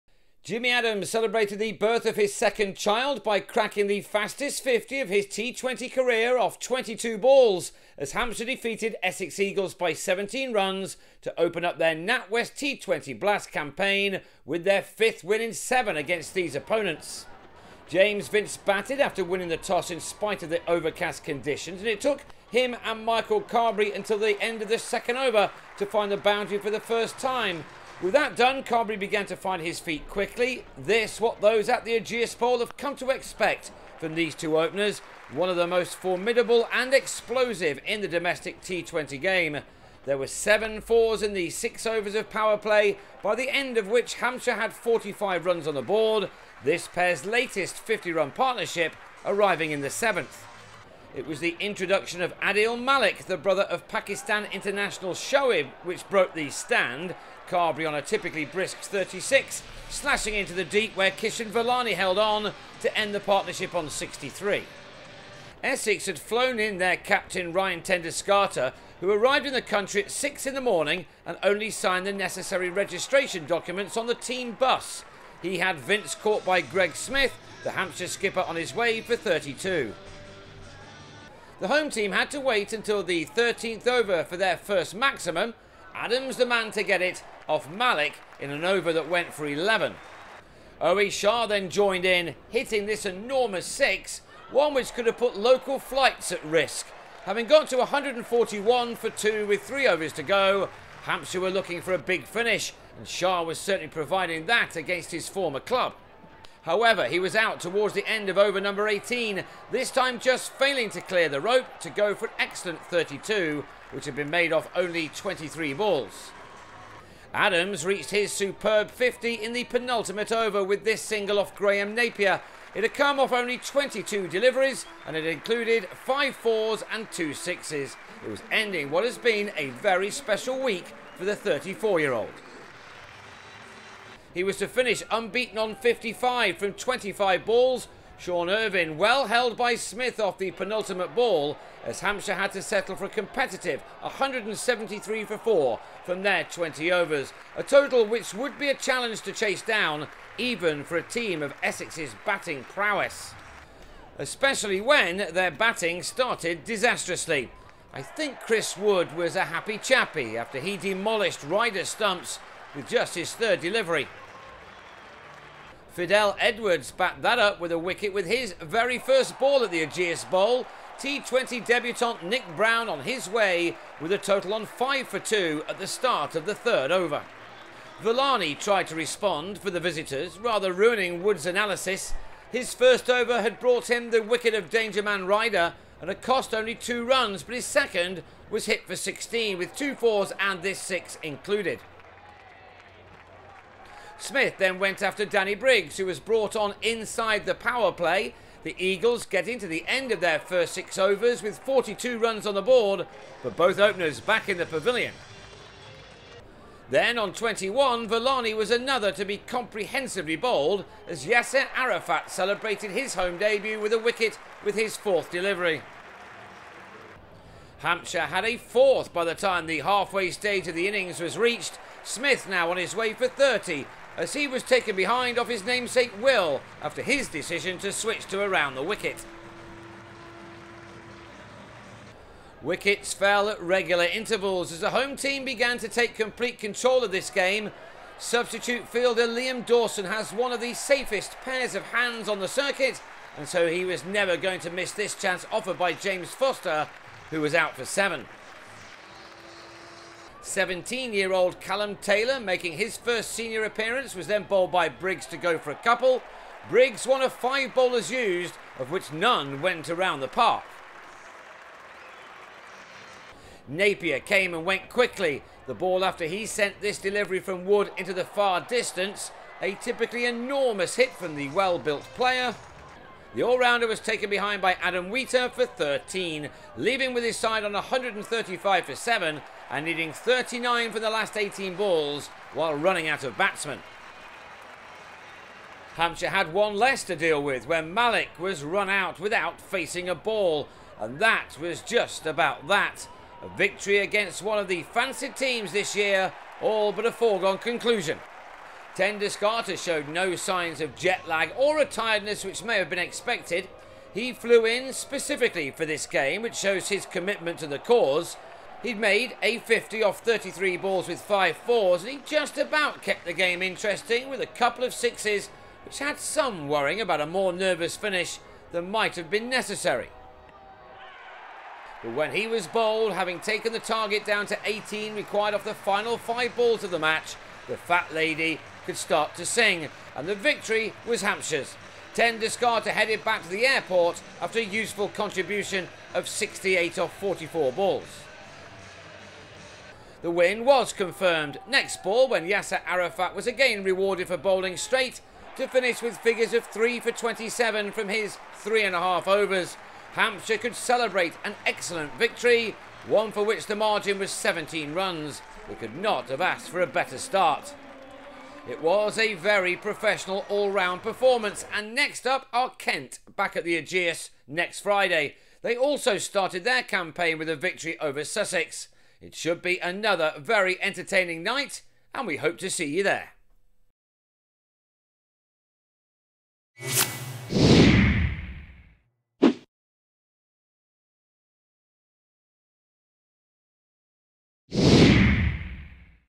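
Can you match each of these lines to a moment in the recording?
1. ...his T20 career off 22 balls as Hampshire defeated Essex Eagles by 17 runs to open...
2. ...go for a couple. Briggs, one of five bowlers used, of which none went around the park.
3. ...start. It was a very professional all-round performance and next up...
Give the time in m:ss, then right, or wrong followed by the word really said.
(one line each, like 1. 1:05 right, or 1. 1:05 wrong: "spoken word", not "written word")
1. 0:05 right
2. 4:15 right
3. 5:57 right.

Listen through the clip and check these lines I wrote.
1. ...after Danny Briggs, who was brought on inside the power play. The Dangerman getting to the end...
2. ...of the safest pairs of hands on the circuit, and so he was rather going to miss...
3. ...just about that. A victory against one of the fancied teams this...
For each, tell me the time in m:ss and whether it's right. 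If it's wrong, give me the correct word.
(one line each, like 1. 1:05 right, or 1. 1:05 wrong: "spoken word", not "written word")
1. 3:15 wrong: "Eagles", not "Dangerman"
2. 4:00 wrong: "never", not "rather"
3. 4:51 right.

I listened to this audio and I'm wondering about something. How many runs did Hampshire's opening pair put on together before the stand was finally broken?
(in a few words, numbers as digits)
63.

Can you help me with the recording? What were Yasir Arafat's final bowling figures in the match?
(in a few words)
3 for 27.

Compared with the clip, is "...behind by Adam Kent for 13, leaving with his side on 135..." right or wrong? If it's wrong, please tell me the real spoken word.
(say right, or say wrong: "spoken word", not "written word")
wrong: "Wheater", not "Kent".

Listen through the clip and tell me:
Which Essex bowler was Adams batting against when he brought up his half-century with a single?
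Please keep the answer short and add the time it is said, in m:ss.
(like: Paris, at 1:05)
Graham Napier, at 2:01.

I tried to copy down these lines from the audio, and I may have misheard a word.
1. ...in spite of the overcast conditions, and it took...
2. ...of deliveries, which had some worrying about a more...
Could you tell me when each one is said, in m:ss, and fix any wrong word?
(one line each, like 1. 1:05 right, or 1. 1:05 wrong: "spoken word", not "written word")
1. 0:19 right
2. 5:14 wrong: "sixes", not "deliveries".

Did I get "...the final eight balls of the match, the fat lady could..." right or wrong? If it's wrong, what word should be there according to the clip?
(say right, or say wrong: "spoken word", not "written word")
wrong: "five", not "eight".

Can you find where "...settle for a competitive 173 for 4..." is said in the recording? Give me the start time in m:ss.
2:22.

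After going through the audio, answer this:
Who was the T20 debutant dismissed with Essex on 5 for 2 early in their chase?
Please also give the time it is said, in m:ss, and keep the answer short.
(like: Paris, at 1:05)
Nick Browne, at 2:52.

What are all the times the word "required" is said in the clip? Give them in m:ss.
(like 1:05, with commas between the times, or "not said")
5:25.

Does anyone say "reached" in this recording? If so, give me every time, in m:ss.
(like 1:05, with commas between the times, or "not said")
1:57, 3:41.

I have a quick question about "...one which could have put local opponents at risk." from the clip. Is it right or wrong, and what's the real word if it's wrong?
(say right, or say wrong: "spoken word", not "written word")
wrong: "flights", not "opponents".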